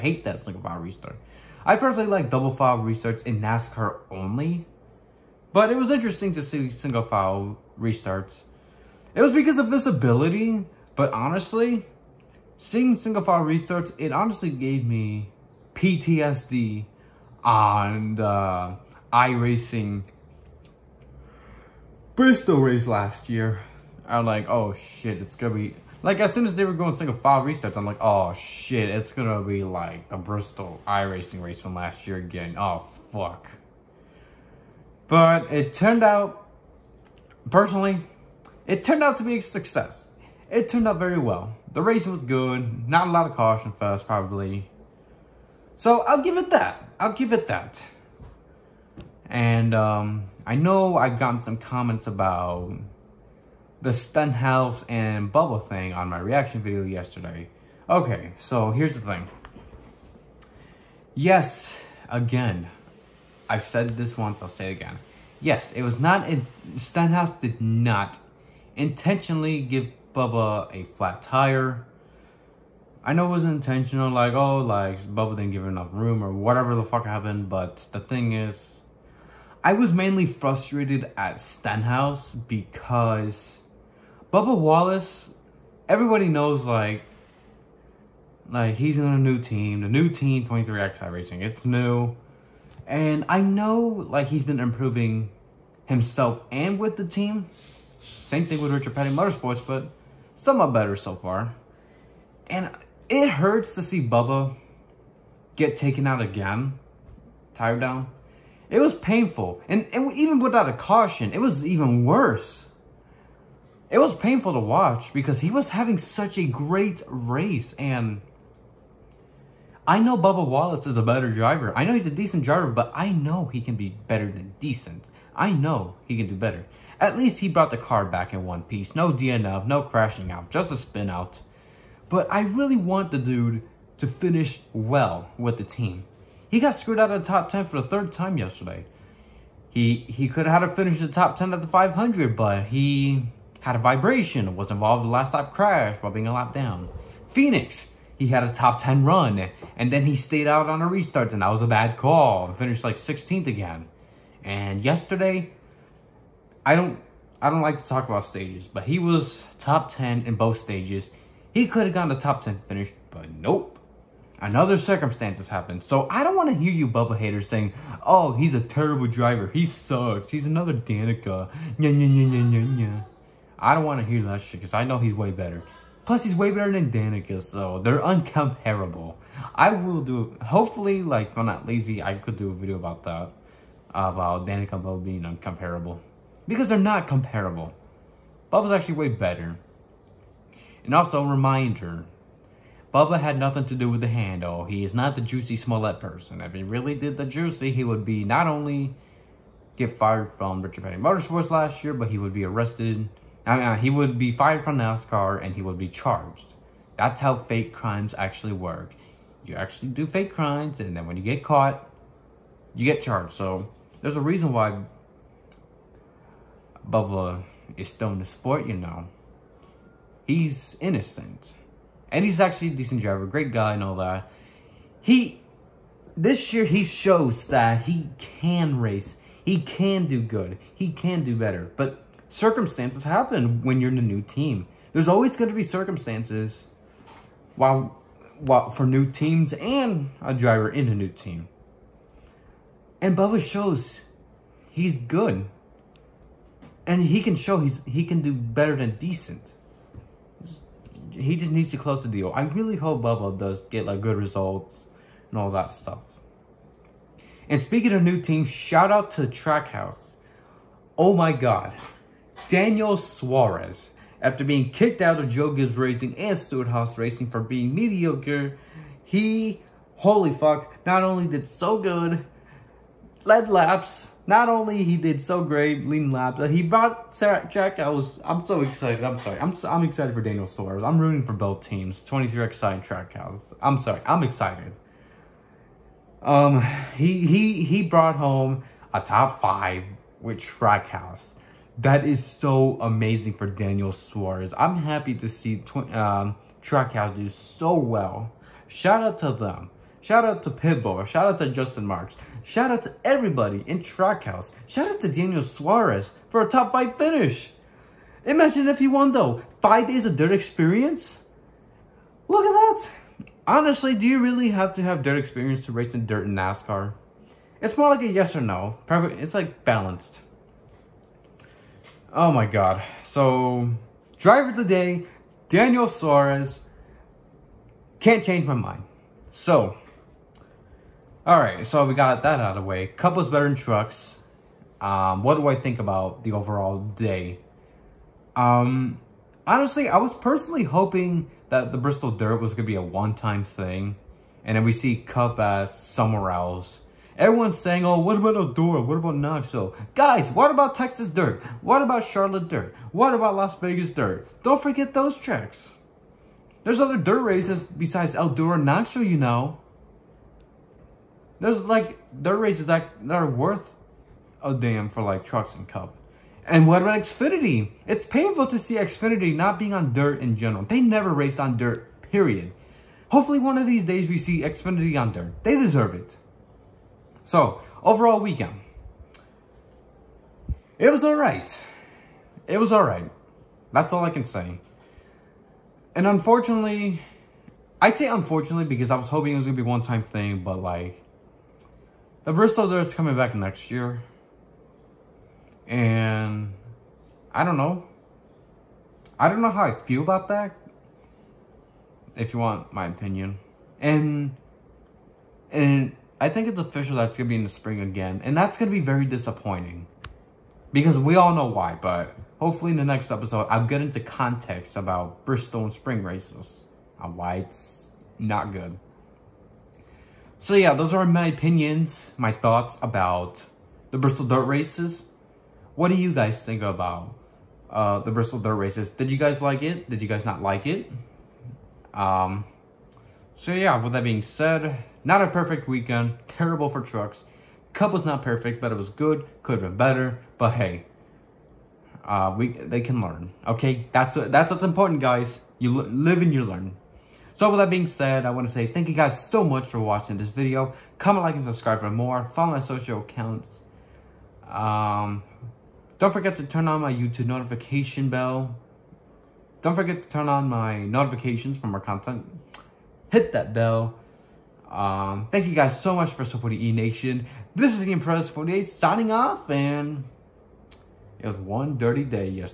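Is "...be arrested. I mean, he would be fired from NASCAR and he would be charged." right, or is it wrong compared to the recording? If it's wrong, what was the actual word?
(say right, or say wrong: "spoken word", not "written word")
right.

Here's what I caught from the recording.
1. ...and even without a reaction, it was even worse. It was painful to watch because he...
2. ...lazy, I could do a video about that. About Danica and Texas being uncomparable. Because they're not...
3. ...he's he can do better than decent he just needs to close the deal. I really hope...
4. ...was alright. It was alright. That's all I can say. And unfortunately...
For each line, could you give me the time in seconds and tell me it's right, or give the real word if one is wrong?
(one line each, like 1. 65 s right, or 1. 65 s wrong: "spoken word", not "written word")
1. 109 s wrong: "caution", not "reaction"
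2. 181 s wrong: "Bubba", not "Texas"
3. 247 s right
4. 380 s right.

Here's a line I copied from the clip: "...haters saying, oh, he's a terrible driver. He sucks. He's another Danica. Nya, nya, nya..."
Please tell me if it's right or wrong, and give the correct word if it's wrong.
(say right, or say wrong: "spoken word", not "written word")
right.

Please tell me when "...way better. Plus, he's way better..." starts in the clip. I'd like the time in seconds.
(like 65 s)
175 s.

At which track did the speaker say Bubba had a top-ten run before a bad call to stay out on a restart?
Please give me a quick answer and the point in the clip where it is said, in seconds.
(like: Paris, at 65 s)
Phoenix, at 147 s.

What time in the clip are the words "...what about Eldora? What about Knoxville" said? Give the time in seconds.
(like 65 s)
347 s.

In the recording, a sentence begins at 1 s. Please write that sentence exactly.
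I personally like double file restarts in NASCAR only, but it was interesting to see single file restarts.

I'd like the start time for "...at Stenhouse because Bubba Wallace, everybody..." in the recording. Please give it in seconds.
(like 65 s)
81 s.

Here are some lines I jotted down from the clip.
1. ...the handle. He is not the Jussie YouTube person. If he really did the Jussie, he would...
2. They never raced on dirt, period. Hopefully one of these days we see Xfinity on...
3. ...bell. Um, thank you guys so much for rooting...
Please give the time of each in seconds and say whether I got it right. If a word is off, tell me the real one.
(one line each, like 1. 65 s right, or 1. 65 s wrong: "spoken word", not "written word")
1. 194 s wrong: "Smollett", not "YouTube"
2. 370 s right
3. 463 s wrong: "supporting", not "rooting".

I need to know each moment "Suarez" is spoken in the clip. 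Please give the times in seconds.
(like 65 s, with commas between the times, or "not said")
262 s, 280 s, 293 s, 305 s, 325 s.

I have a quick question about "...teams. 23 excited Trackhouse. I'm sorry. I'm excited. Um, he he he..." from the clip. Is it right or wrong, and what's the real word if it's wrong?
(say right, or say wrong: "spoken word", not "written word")
right.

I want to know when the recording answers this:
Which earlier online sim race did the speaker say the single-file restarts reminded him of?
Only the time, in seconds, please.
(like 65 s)
19 s.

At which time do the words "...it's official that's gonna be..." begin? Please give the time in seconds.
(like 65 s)
406 s.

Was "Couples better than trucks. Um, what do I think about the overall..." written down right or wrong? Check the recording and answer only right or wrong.
right.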